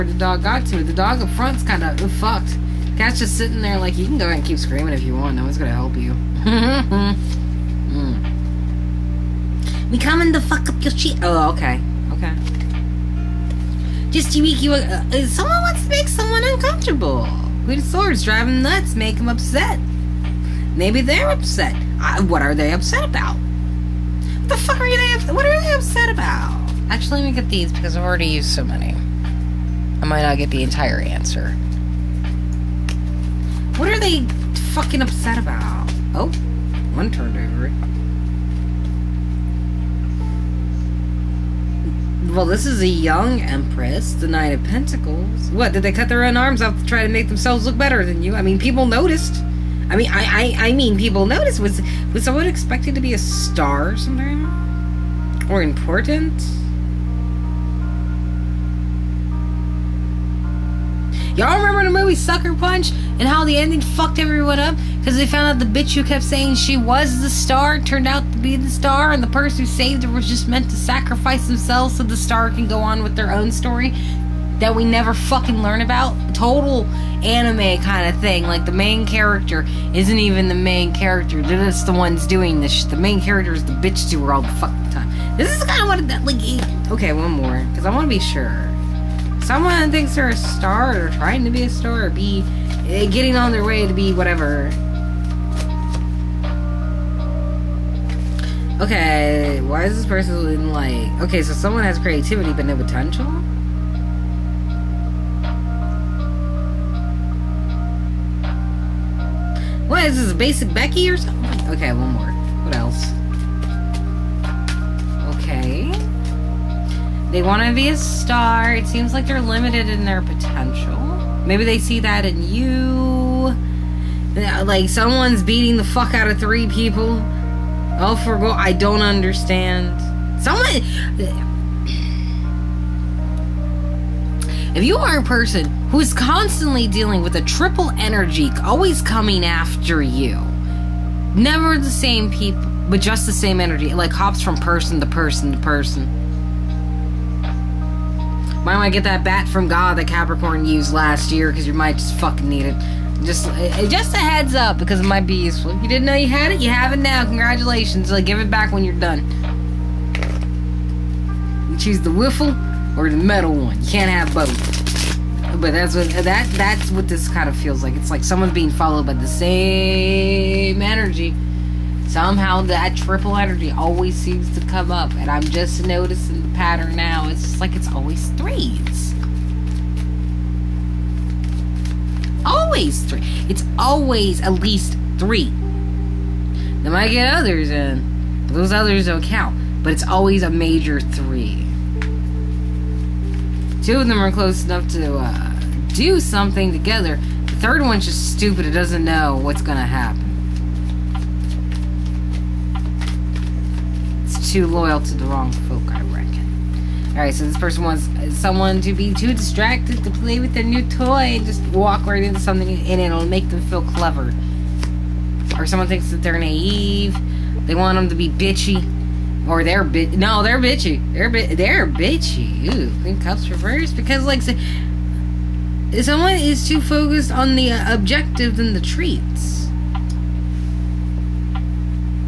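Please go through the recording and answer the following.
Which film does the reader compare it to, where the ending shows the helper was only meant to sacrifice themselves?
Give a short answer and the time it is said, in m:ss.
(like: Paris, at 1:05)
Sucker Punch, at 1:02.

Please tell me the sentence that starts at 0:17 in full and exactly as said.
Queen of Swords driving nuts, make them upset.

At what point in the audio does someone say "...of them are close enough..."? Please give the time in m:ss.
3:14.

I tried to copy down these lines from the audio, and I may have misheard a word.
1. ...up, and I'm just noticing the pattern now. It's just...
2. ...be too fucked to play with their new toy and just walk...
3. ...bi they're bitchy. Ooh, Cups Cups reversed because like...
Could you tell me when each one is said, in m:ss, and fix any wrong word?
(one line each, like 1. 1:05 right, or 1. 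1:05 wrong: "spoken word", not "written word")
1. 2:54 right
2. 3:28 wrong: "distracted", not "fucked"
3. 3:41 wrong: "Queen", not "Cups".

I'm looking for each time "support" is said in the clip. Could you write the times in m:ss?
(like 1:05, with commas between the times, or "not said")
not said.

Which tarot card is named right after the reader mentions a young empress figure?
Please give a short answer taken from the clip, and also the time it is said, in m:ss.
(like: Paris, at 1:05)
Nine of Pentacles, at 0:44.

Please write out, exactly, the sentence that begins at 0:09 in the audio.
We coming to fuck up your shit.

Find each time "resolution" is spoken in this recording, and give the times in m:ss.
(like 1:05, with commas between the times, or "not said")
not said.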